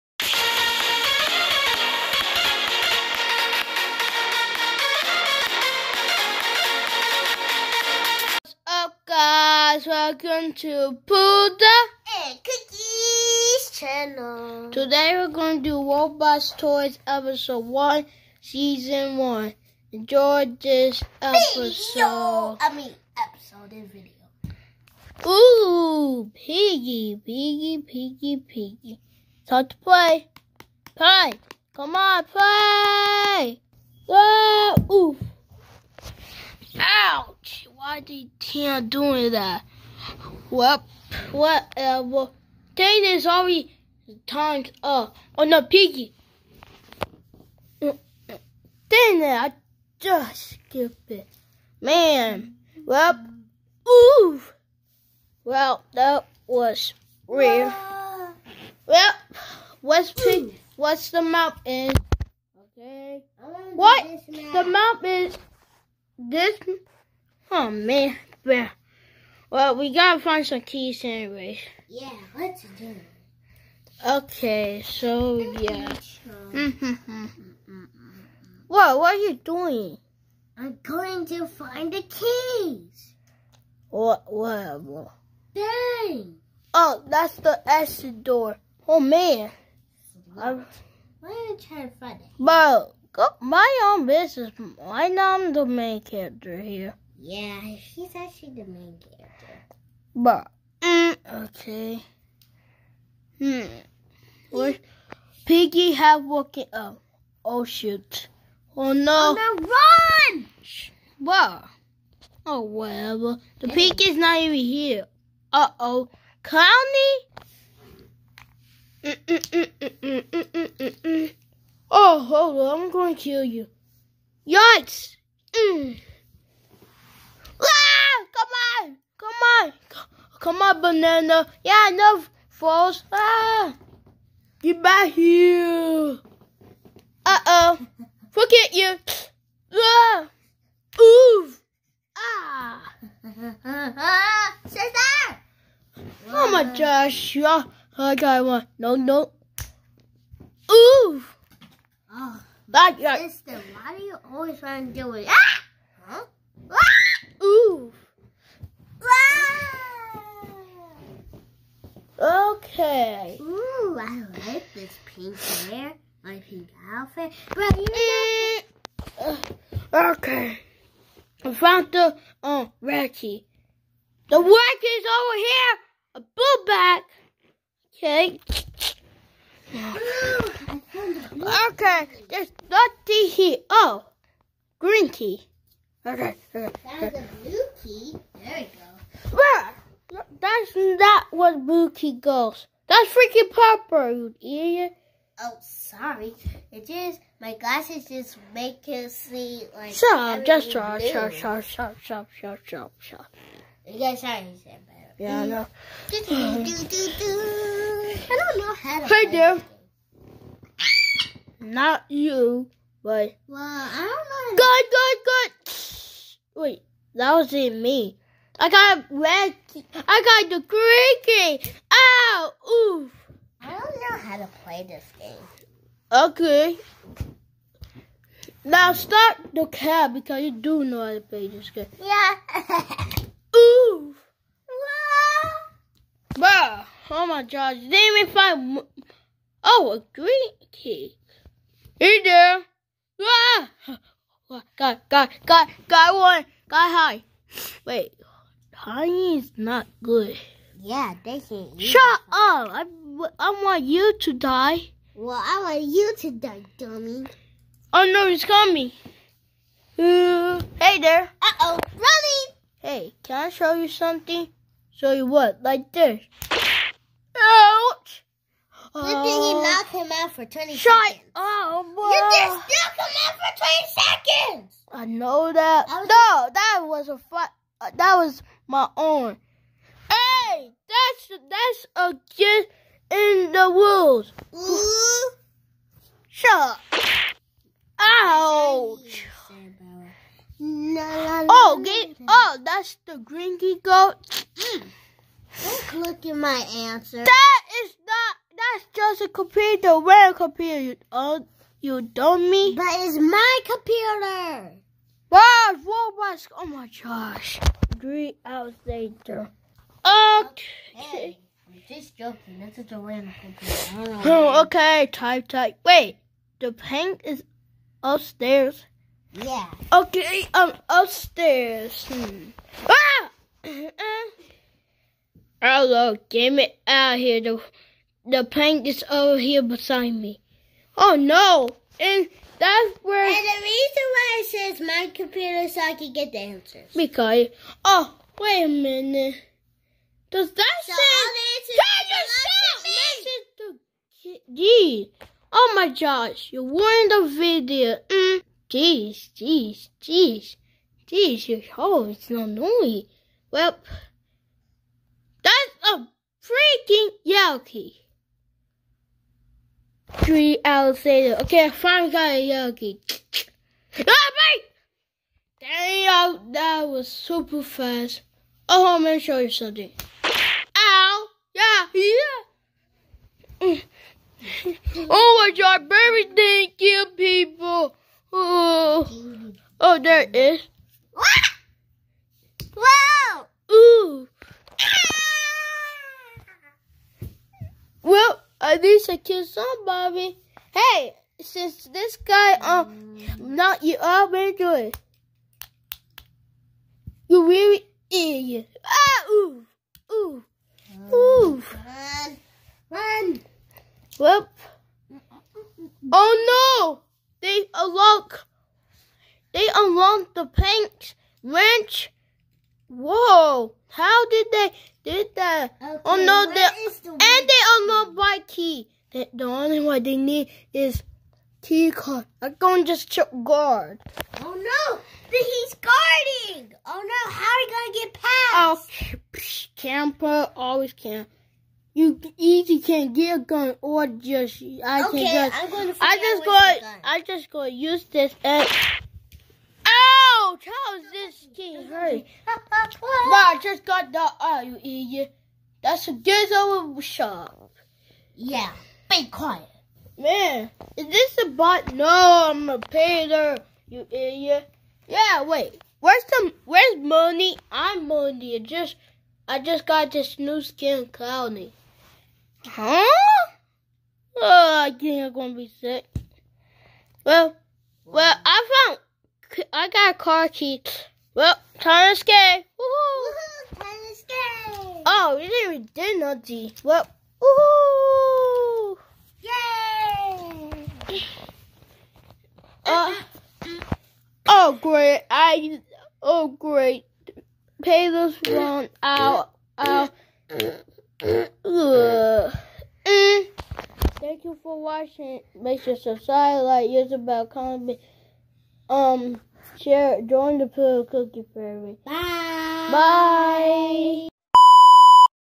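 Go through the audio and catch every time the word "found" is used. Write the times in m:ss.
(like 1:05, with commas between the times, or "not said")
2:51, 7:48.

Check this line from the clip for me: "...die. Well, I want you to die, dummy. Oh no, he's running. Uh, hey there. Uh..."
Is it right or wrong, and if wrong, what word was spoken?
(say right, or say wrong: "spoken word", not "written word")
wrong: "coming", not "running".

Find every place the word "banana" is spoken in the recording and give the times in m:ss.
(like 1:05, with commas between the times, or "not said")
2:10.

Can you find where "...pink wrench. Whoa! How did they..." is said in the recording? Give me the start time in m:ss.
6:50.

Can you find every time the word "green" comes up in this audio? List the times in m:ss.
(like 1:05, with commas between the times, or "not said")
3:04, 3:40, 4:00.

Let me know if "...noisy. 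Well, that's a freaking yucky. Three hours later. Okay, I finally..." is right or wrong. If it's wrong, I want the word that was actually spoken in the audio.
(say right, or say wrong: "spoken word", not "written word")
right.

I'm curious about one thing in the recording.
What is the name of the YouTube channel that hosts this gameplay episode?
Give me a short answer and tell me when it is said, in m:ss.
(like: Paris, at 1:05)
Pooda and Cookies, at 0:11.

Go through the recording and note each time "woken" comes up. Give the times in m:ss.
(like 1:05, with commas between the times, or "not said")
1:46.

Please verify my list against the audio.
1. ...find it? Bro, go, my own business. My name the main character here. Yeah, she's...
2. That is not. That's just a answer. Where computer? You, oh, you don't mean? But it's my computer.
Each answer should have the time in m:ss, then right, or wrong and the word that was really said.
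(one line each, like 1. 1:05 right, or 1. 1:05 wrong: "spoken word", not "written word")
1. 1:31 right
2. 4:57 wrong: "computer", not "answer".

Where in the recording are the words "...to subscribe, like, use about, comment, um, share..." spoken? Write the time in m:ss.
8:15.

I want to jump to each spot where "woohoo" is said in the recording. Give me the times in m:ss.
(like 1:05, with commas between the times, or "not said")
7:52, 8:01.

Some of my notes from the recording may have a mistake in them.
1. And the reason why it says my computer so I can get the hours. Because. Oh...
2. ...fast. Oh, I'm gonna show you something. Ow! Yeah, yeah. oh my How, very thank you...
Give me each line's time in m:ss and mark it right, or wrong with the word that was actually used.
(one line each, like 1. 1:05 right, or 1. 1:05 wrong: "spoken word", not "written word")
1. 5:33 wrong: "answers", not "hours"
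2. 6:07 wrong: "God", not "How".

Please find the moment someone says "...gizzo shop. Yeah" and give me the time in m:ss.
7:26.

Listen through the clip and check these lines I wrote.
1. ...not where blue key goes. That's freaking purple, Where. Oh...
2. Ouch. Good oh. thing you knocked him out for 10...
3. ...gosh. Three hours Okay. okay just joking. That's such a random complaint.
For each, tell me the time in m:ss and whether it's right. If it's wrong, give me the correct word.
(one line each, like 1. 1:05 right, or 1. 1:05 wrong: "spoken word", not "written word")
1. 3:10 wrong: "Yeah", not "Where"
2. 4:27 wrong: "20", not "10"
3. 5:07 right.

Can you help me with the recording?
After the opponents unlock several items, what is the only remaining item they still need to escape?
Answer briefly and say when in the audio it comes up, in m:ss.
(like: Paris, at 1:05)
key card, at 7:01.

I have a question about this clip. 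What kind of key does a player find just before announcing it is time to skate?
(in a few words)
car key.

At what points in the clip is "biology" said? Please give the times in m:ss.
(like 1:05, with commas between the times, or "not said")
not said.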